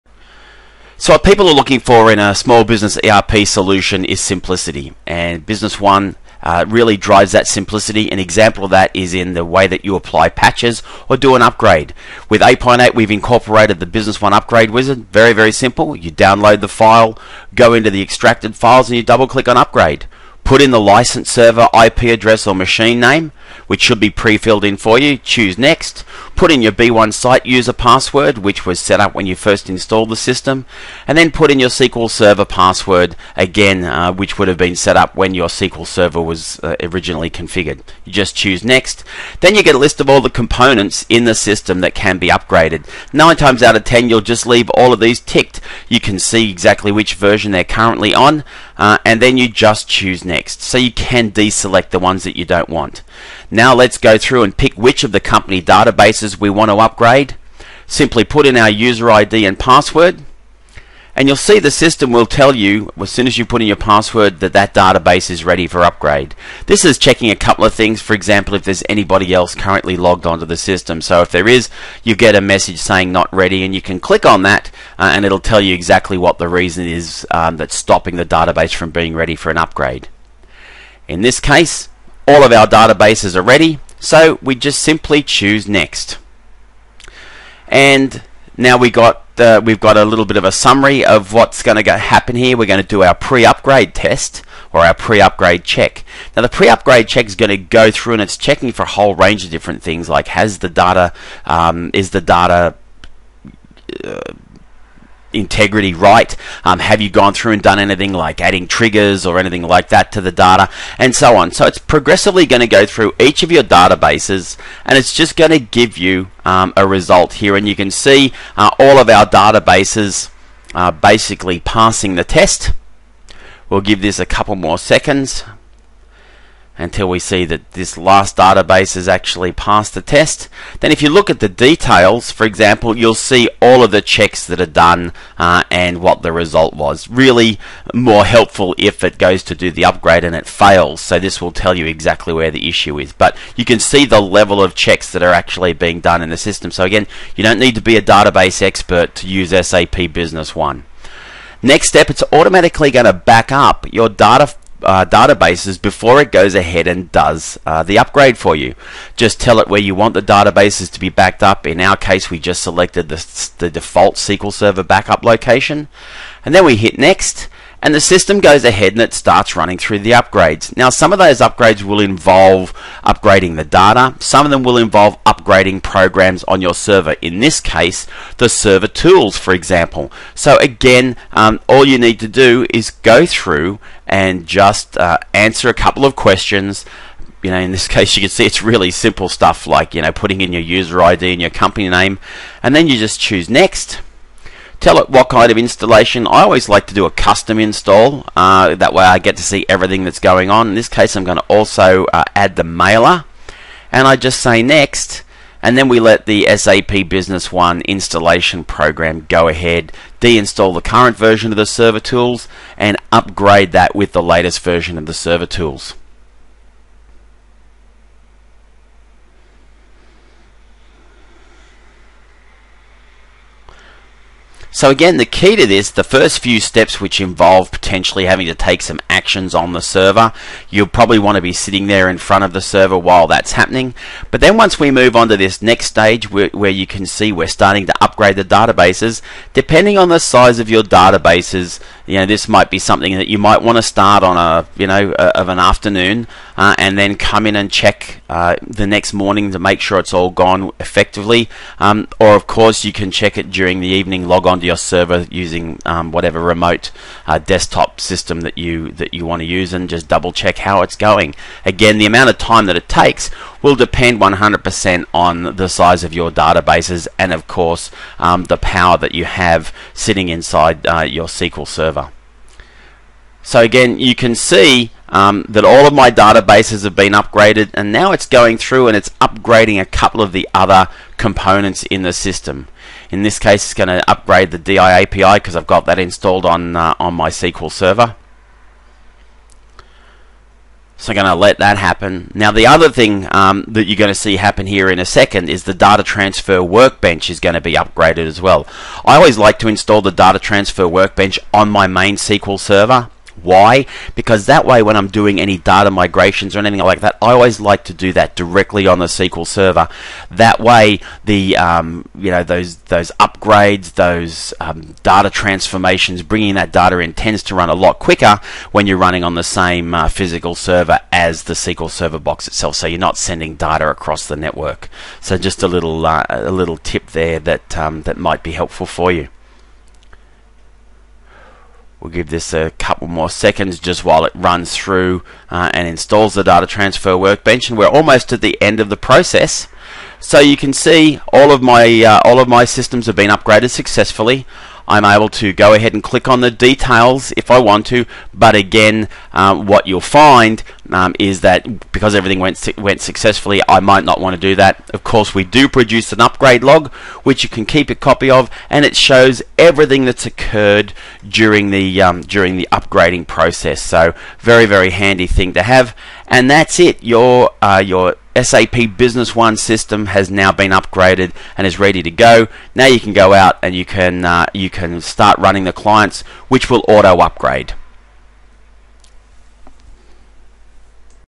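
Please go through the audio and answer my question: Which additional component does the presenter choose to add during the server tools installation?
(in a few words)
mailer.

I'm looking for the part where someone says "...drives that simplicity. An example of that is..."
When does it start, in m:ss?
0:06.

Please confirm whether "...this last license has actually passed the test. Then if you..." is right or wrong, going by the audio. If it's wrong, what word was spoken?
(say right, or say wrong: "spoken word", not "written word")
wrong: "database", not "license".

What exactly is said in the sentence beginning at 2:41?
In our case, we just selected the, the default SQL Server backup location.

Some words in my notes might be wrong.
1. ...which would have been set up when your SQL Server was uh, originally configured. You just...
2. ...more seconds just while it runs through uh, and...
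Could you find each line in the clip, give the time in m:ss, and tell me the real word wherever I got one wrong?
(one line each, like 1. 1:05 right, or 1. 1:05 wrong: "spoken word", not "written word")
1. 0:34 right
2. 5:33 right.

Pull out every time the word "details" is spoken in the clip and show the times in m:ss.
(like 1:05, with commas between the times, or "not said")
2:11, 5:46.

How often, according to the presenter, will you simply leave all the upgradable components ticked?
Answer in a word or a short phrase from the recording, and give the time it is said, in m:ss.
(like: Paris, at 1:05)
Nine times out of ten, at 0:43.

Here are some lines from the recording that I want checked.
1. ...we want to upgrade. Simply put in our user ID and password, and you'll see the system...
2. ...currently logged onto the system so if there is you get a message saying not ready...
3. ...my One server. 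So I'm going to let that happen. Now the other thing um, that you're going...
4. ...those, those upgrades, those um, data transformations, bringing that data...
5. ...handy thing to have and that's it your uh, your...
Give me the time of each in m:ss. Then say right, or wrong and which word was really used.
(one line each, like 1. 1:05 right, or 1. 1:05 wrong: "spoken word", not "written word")
1. 0:56 right
2. 1:09 right
3. 4:47 wrong: "SQL", not "One"
4. 5:12 right
5. 6:04 right.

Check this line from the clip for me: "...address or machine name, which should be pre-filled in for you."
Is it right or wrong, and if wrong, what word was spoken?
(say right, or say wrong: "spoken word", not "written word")
right.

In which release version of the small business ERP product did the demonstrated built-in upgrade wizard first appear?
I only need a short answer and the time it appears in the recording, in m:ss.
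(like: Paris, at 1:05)
8.8, at 0:12.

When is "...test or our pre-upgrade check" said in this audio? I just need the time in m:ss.
1:33.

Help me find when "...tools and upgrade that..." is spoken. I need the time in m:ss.
3:31.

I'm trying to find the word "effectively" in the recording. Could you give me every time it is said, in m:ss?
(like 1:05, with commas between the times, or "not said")
4:10.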